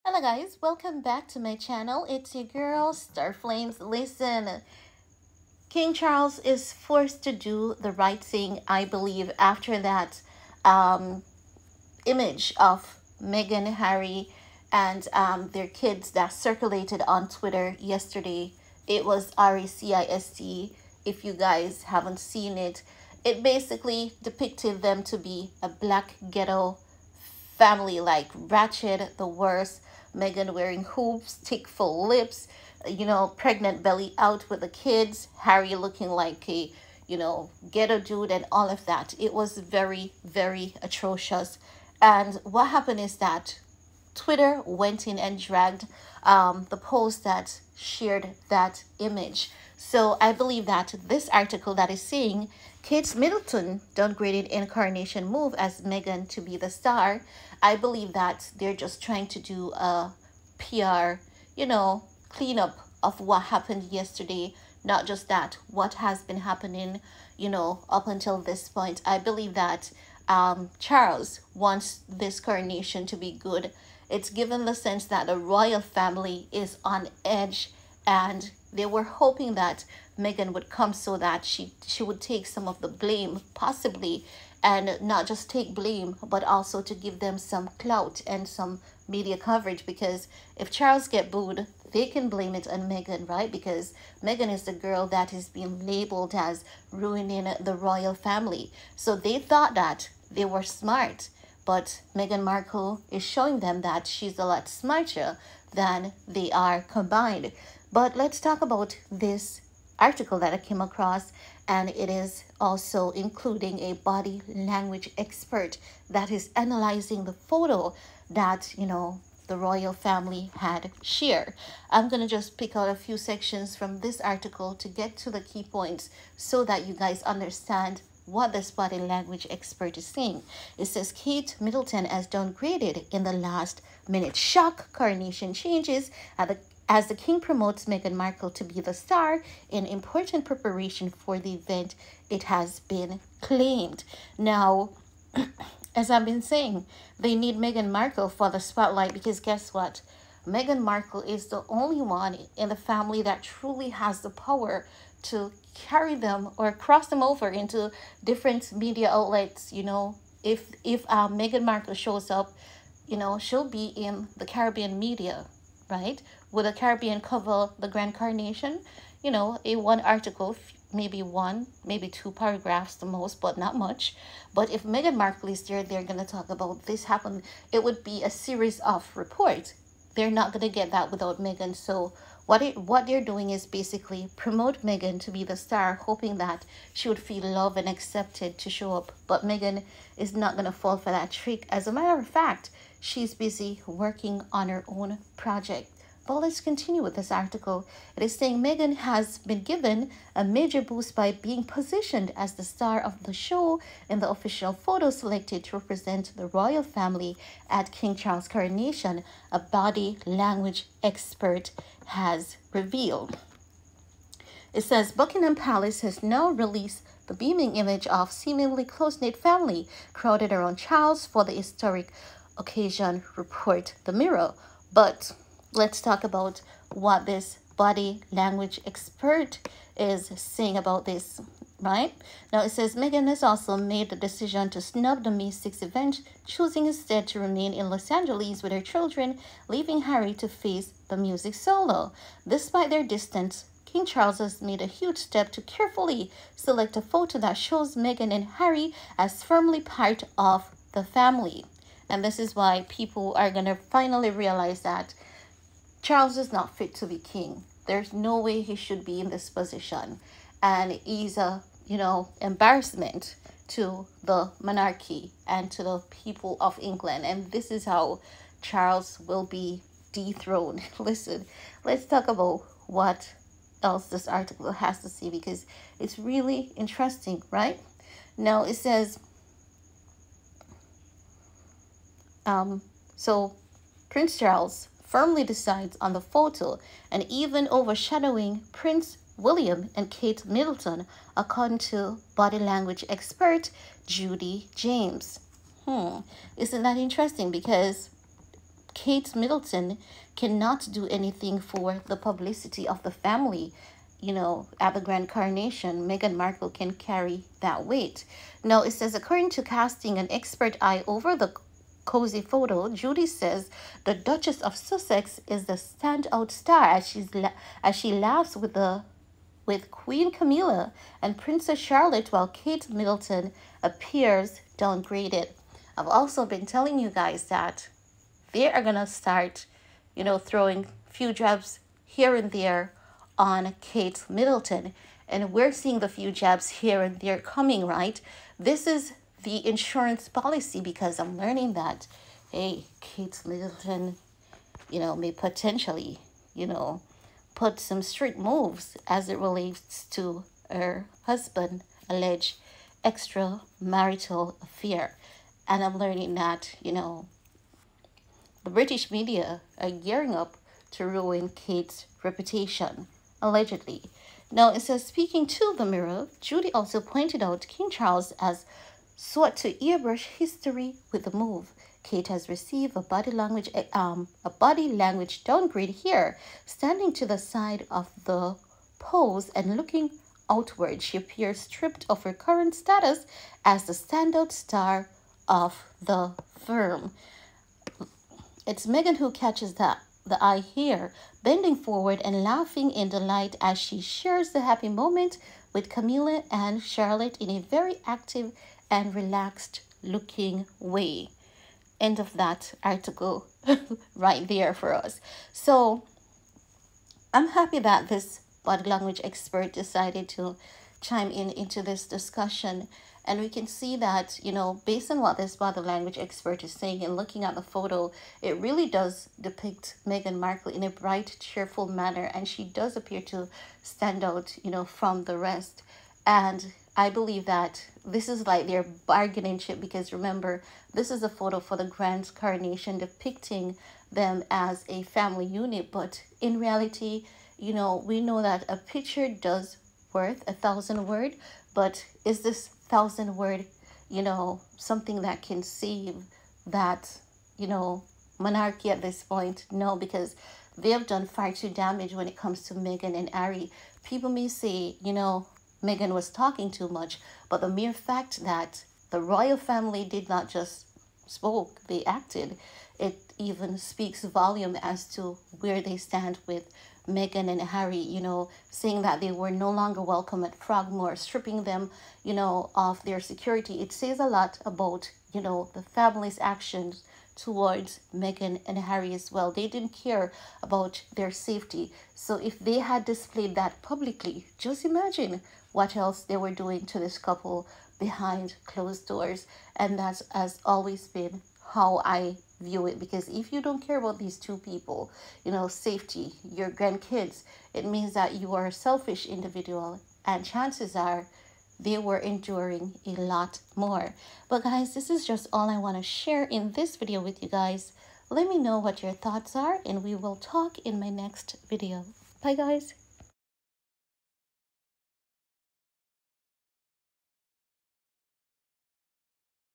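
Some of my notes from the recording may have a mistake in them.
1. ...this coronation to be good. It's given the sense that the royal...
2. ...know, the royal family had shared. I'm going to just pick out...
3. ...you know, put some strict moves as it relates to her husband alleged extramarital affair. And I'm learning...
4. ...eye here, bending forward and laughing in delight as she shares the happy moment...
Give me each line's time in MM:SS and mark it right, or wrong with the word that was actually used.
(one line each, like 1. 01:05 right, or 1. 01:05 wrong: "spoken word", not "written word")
1. 01:12 right
2. 01:58 right
3. 05:46 right
4. 06:30 right.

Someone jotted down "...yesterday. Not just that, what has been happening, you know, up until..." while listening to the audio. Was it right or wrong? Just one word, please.
right.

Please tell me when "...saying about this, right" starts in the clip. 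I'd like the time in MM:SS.
03:50.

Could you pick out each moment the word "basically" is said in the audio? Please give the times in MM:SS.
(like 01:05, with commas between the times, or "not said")
00:23, 03:03.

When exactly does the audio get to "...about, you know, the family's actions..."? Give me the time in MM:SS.
07:54.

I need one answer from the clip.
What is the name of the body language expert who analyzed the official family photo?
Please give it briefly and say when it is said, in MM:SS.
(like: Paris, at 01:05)
Judy James, at 04:54.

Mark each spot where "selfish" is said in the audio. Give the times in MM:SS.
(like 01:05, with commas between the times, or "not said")
08:18.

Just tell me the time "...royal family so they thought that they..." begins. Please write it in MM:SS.
01:37.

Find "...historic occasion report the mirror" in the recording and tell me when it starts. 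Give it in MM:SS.
03:41.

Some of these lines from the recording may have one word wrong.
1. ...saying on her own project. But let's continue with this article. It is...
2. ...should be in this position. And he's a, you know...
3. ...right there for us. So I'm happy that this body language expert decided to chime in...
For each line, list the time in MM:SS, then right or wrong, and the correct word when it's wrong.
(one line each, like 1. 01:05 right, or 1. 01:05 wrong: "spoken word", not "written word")
1. 03:13 wrong: "working", not "saying"
2. 04:18 right
3. 06:44 right.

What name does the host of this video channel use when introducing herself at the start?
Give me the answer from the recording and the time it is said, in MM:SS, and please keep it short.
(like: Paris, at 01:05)
Star Flames, at 00:02.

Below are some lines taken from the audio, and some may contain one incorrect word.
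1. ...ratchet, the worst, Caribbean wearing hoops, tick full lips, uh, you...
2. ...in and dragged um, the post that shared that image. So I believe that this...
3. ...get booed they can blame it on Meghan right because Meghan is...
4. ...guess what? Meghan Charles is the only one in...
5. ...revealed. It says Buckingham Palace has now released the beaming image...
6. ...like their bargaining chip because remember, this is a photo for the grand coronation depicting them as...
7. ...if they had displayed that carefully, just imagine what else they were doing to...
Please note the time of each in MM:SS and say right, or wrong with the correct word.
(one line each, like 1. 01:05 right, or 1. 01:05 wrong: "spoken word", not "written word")
1. 00:28 wrong: "Meghan", not "Caribbean"
2. 00:45 right
3. 01:31 right
4. 02:29 wrong: "Markle", not "Charles"
5. 03:32 right
6. 07:08 right
7. 08:02 wrong: "publicly", not "carefully".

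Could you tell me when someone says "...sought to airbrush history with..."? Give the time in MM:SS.
06:09.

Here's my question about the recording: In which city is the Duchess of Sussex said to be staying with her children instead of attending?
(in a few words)
Los Angeles.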